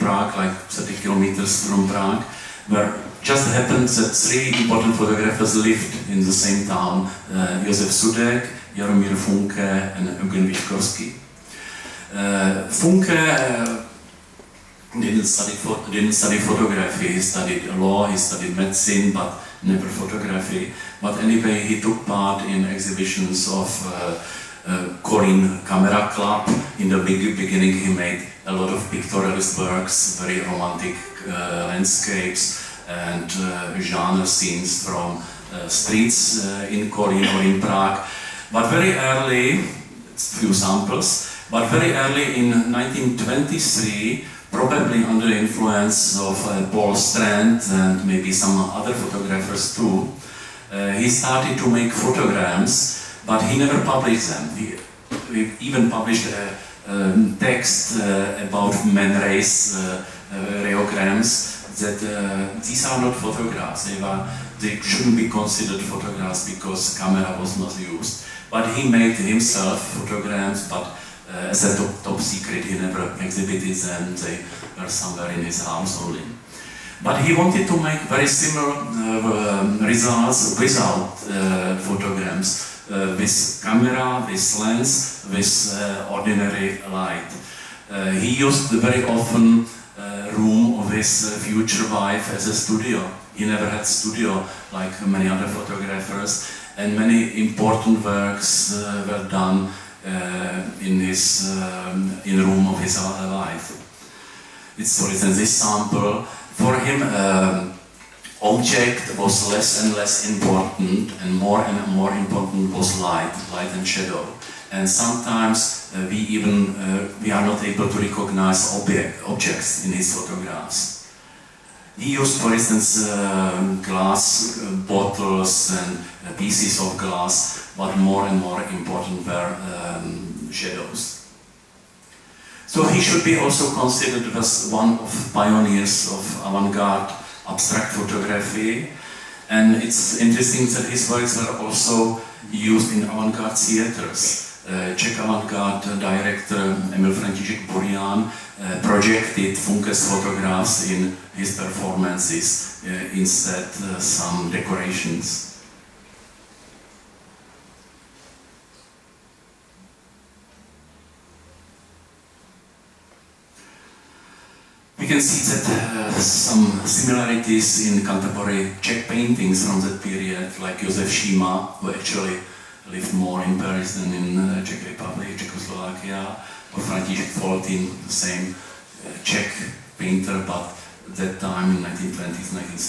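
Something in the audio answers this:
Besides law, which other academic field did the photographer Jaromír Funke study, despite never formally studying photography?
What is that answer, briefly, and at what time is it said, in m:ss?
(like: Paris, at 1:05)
Medicine, at 0:18.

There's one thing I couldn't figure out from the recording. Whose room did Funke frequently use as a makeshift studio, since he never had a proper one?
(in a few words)
His future wife's.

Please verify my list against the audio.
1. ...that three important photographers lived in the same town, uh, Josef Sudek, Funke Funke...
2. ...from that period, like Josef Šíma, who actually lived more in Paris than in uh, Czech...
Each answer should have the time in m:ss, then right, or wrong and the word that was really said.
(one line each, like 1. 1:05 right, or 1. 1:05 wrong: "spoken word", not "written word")
1. 0:03 wrong: "Jaromír", not "Funke"
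2. 2:49 right.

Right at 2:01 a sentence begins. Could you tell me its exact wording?
He used, for instance, uh, glass bottles and pieces of glass but more and more important were um, shadows.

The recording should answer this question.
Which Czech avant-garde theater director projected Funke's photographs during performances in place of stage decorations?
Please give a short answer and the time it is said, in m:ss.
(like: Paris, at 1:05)
Emil František Burian, at 2:26.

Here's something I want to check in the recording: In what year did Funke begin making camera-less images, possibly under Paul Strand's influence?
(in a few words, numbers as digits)
1923.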